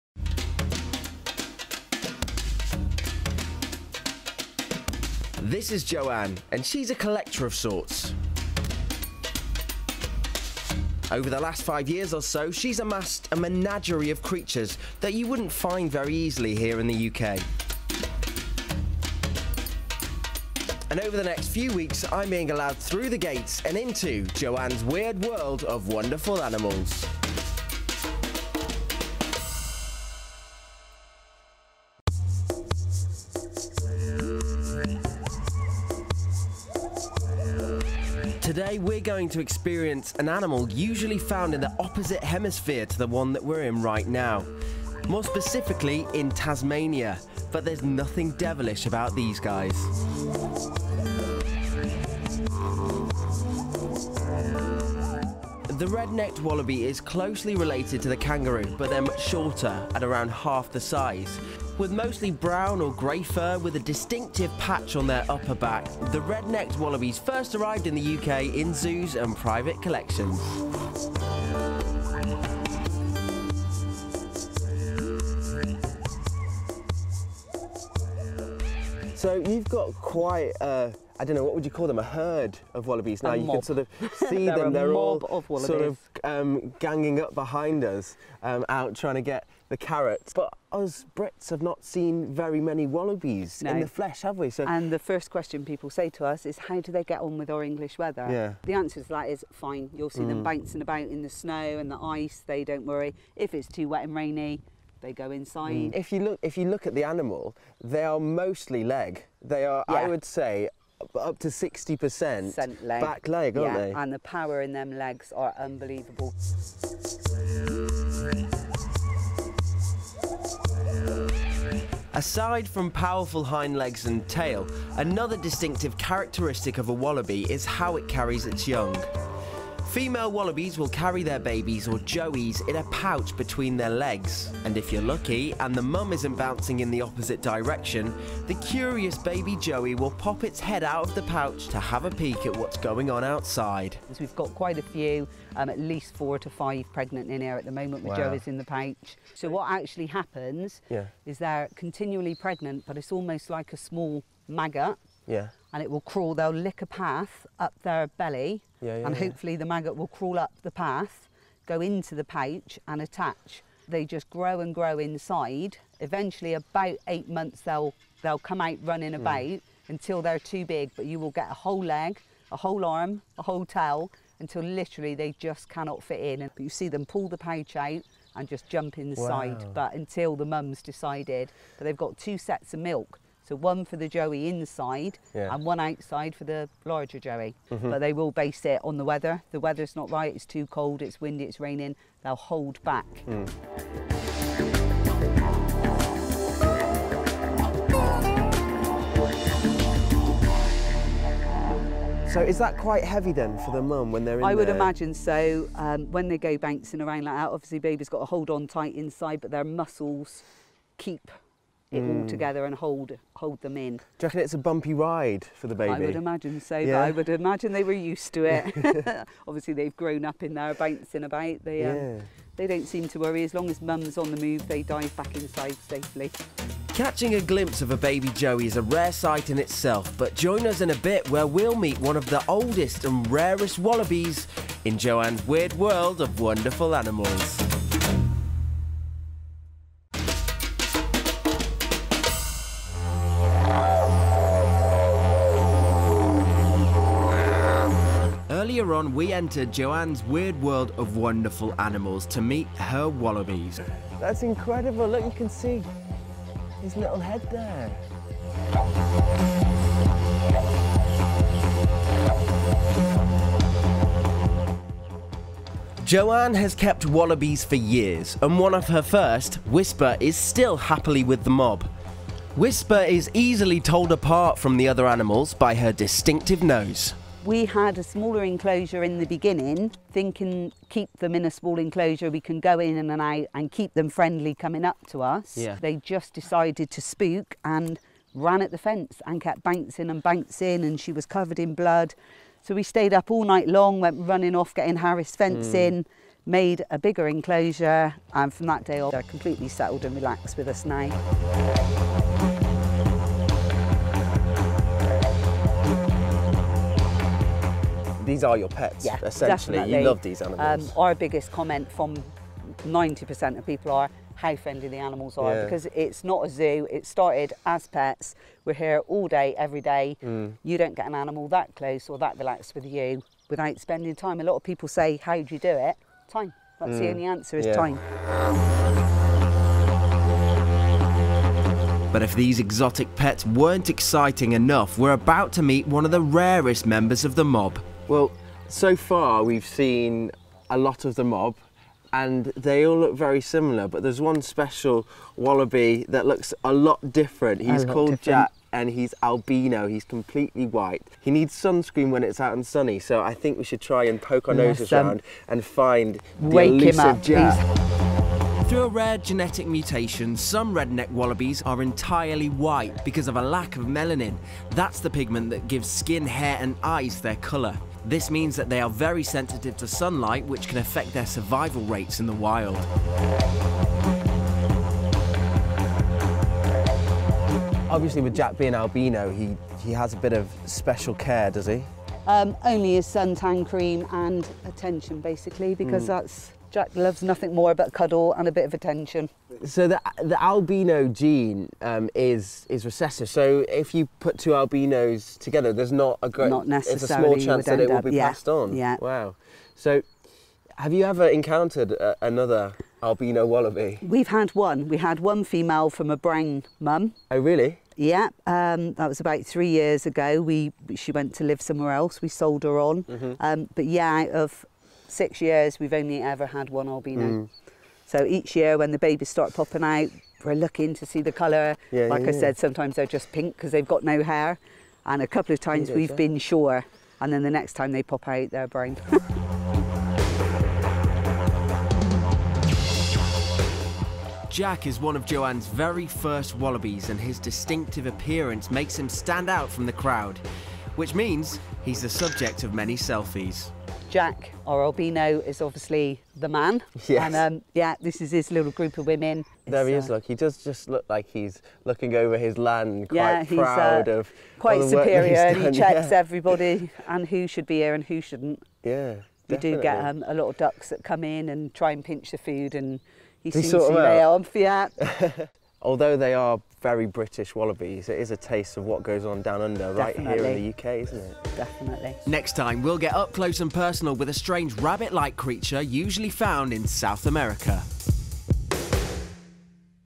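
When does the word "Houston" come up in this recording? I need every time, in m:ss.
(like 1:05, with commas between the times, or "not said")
not said.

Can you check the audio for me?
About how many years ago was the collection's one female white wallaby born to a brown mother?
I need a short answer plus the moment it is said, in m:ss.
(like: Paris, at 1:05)
3, at 6:49.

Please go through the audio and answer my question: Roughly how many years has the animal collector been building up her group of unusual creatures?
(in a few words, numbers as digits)
5.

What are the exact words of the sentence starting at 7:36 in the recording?
everybody and who should be here and who shouldn't.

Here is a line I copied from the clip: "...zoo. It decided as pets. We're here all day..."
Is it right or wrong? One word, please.
wrong.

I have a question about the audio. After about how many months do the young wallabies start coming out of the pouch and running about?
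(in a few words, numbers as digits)
8.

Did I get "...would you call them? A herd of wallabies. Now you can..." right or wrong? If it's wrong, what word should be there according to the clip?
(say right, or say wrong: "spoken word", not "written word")
right.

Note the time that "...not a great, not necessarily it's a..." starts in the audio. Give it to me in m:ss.
6:35.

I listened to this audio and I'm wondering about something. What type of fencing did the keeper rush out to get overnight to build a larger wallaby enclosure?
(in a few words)
Heras fencing.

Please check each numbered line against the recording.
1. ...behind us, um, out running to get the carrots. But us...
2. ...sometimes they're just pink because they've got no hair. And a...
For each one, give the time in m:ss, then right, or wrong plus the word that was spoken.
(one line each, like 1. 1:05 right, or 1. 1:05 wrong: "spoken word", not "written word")
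1. 1:27 wrong: "trying", not "running"
2. 7:02 right.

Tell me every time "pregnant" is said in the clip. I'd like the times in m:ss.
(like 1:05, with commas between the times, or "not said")
2:26, 2:32.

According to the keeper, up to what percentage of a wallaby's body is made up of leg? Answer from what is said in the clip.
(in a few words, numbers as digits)
60%.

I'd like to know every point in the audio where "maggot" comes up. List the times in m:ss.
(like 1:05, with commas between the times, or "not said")
2:34, 2:39.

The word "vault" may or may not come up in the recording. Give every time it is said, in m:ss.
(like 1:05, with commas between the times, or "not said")
not said.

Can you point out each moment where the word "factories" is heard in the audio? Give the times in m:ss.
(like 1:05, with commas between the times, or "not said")
not said.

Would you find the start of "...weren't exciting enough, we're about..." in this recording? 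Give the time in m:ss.
5:33.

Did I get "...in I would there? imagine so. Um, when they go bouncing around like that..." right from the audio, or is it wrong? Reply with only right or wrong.
right.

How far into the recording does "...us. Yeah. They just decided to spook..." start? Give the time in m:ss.
4:45.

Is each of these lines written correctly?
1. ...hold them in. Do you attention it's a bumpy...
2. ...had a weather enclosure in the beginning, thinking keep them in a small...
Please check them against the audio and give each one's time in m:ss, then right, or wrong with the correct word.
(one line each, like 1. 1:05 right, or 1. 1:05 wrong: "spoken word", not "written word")
1. 3:33 wrong: "reckon", not "attention"
2. 4:37 wrong: "smaller", not "weather".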